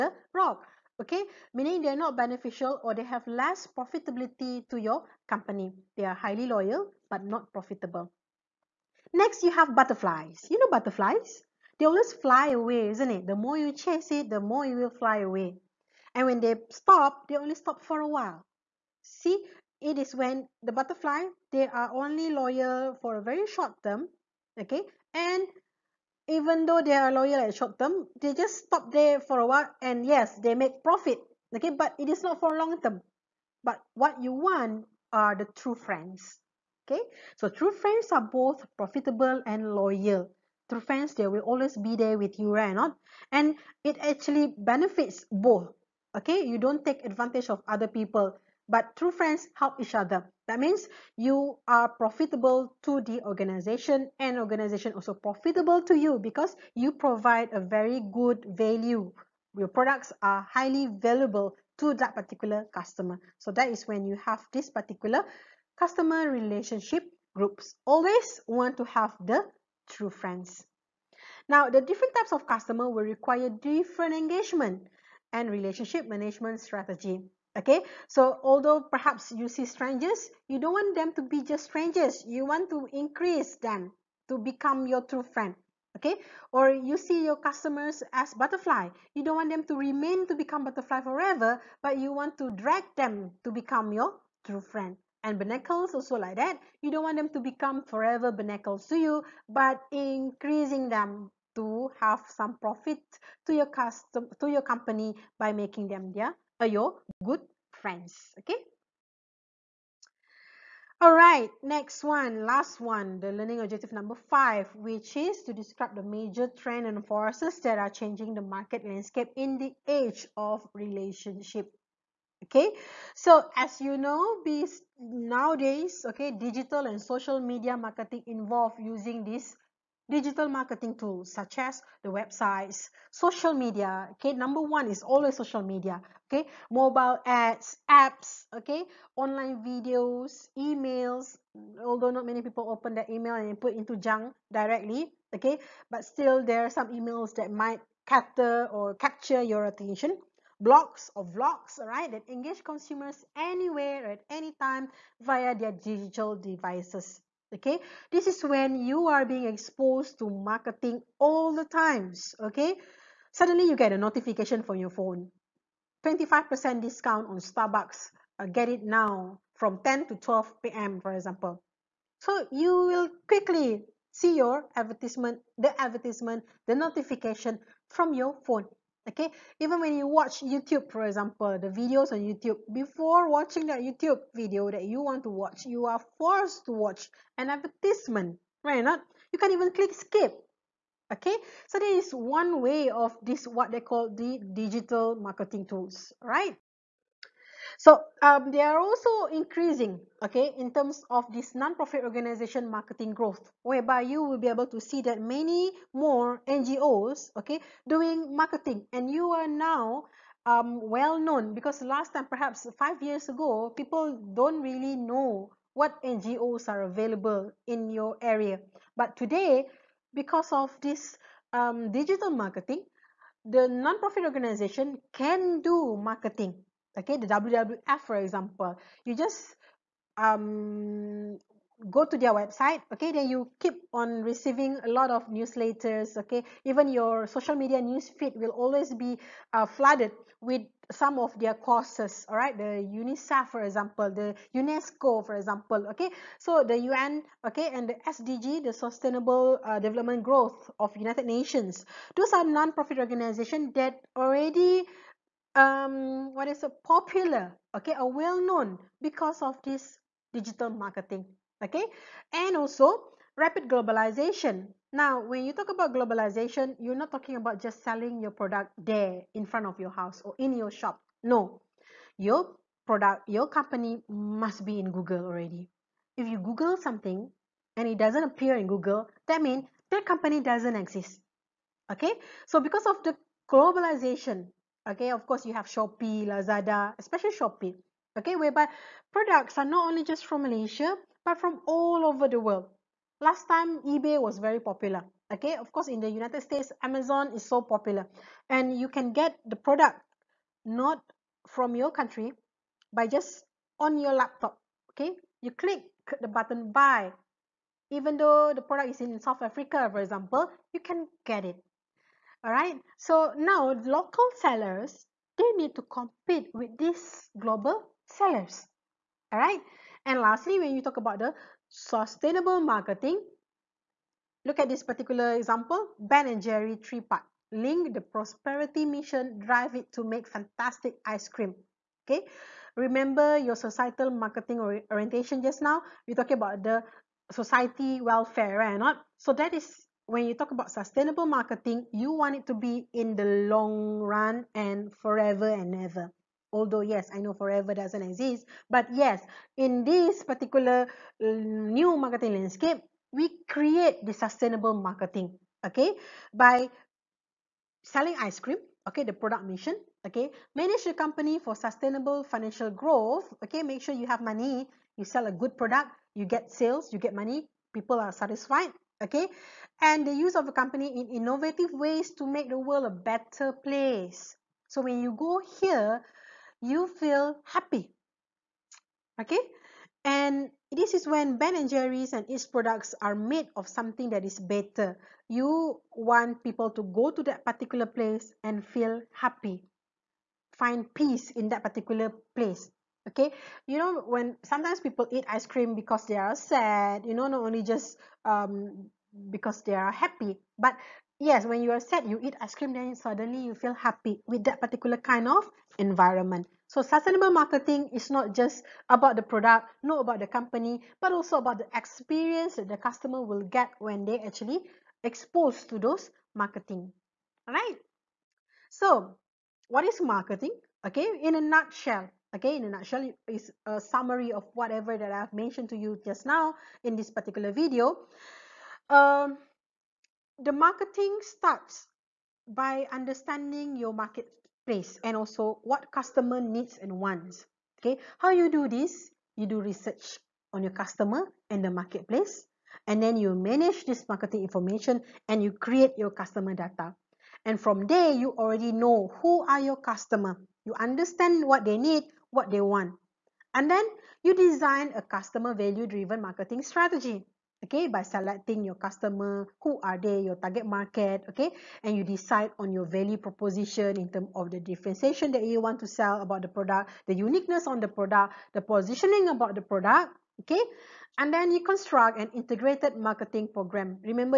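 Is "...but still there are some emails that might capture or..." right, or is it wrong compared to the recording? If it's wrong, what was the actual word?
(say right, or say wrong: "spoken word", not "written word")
right.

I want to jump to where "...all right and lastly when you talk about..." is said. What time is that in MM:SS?
05:19.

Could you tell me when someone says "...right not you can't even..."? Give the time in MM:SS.
03:08.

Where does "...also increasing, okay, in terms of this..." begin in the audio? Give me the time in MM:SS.
03:18.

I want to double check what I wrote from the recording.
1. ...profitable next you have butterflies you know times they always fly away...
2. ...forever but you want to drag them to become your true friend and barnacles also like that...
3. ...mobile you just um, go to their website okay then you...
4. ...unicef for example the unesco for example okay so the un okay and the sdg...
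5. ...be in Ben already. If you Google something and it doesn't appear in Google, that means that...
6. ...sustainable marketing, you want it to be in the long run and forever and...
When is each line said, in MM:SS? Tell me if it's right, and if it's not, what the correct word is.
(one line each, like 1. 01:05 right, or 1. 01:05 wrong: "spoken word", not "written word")
1. 00:07 wrong: "butterflies", not "times"
2. 01:31 right
3. 03:48 wrong: "example", not "mobile"
4. 04:02 right
5. 04:34 wrong: "Google", not "Ben"
6. 05:40 right.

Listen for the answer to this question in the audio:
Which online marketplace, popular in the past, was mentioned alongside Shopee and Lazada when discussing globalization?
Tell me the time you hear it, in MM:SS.
04:53.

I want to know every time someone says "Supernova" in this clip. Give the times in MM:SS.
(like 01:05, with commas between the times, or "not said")
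not said.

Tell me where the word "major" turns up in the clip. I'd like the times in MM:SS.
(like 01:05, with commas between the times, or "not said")
01:56.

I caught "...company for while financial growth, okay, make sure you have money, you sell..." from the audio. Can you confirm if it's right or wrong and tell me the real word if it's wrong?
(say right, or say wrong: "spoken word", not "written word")
wrong: "sustainable", not "while".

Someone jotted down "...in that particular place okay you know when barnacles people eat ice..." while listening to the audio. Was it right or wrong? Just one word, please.
wrong.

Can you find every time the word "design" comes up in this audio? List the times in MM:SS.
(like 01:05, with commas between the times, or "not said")
07:34.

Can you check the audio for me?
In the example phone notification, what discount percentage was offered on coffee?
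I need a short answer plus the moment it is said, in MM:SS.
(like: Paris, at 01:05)
25%, at 02:46.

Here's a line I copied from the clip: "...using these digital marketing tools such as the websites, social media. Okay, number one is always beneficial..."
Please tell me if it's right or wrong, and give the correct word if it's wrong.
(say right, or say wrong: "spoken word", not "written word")
wrong: "social", not "beneficial".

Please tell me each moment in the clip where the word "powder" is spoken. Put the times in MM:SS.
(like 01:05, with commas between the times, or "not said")
not said.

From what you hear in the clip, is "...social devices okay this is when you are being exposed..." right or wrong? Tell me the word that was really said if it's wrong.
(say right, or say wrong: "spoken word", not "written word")
wrong: "digital", not "social".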